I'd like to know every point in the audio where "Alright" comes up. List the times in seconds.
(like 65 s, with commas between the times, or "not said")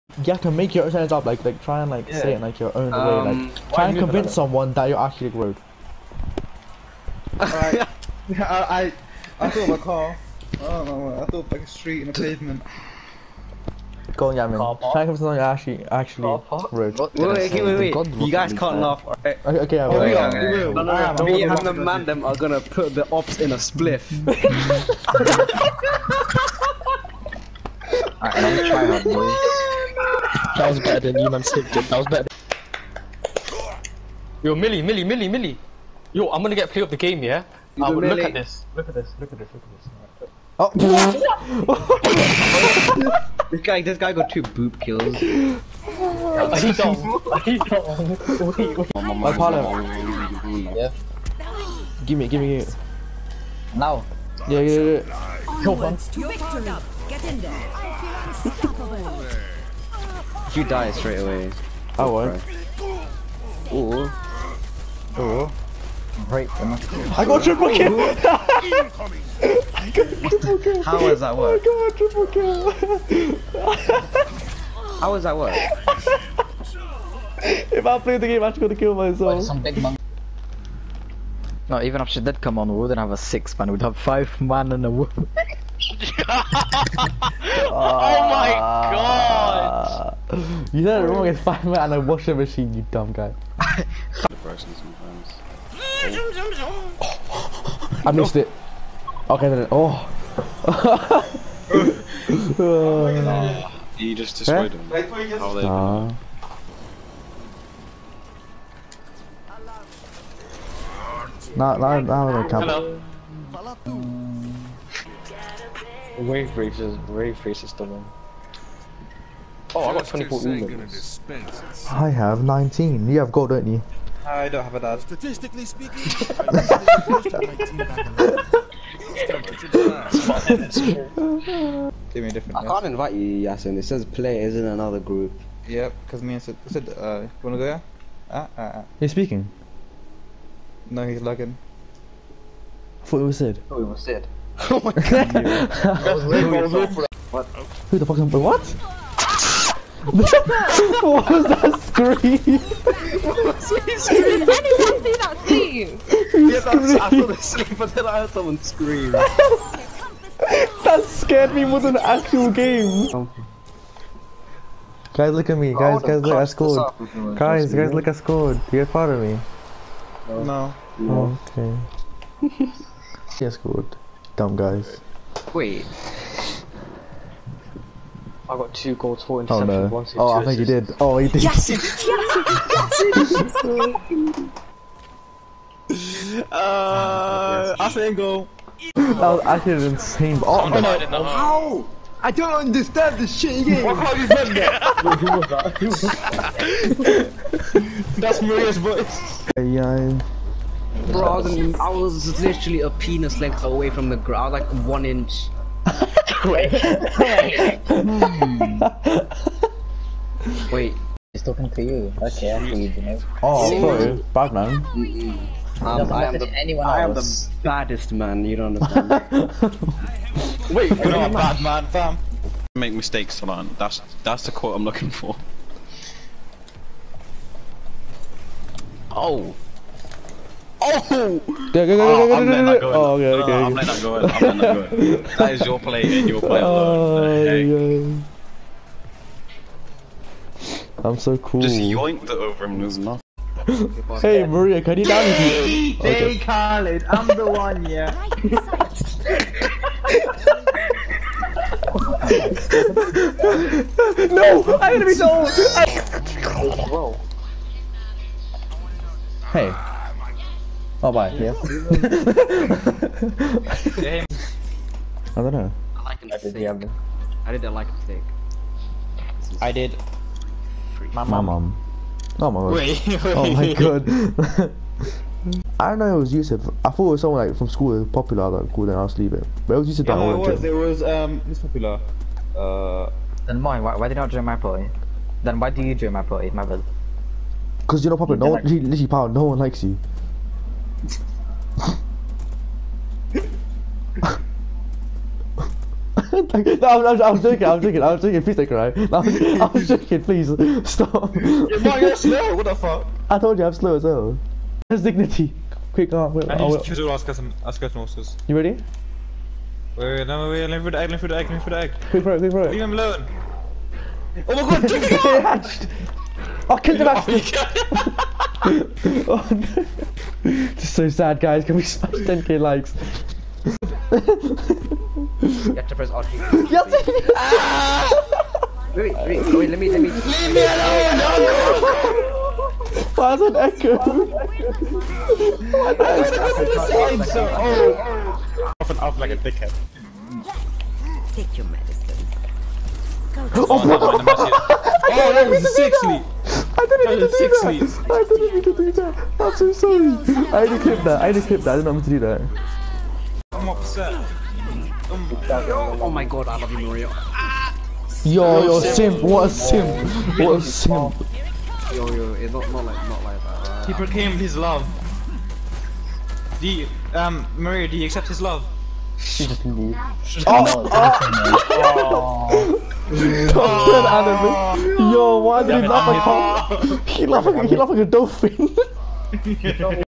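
7 s, 28 s.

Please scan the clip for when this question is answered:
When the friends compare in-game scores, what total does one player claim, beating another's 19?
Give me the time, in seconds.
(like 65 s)
120 s.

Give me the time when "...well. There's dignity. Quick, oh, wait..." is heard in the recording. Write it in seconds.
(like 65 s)
304 s.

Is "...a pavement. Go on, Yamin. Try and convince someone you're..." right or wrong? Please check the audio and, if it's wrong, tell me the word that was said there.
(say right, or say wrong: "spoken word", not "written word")
right.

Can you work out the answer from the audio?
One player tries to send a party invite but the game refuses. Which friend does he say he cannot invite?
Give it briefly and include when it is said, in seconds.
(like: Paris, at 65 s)
Yasin, at 133 s.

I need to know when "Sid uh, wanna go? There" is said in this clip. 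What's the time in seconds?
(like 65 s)
136 s.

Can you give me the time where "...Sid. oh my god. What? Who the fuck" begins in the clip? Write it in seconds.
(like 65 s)
144 s.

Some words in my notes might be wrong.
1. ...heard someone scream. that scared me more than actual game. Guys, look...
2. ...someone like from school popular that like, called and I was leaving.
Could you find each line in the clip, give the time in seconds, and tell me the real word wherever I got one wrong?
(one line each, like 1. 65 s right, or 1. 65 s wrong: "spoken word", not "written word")
1. 158 s right
2. 277 s right.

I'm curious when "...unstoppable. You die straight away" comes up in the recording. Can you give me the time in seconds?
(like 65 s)
58 s.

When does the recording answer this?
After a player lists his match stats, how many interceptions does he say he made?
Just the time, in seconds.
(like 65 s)
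179 s.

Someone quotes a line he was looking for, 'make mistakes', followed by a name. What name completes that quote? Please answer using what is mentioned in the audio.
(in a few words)
Solan.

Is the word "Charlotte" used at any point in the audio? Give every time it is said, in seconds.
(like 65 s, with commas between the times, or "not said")
not said.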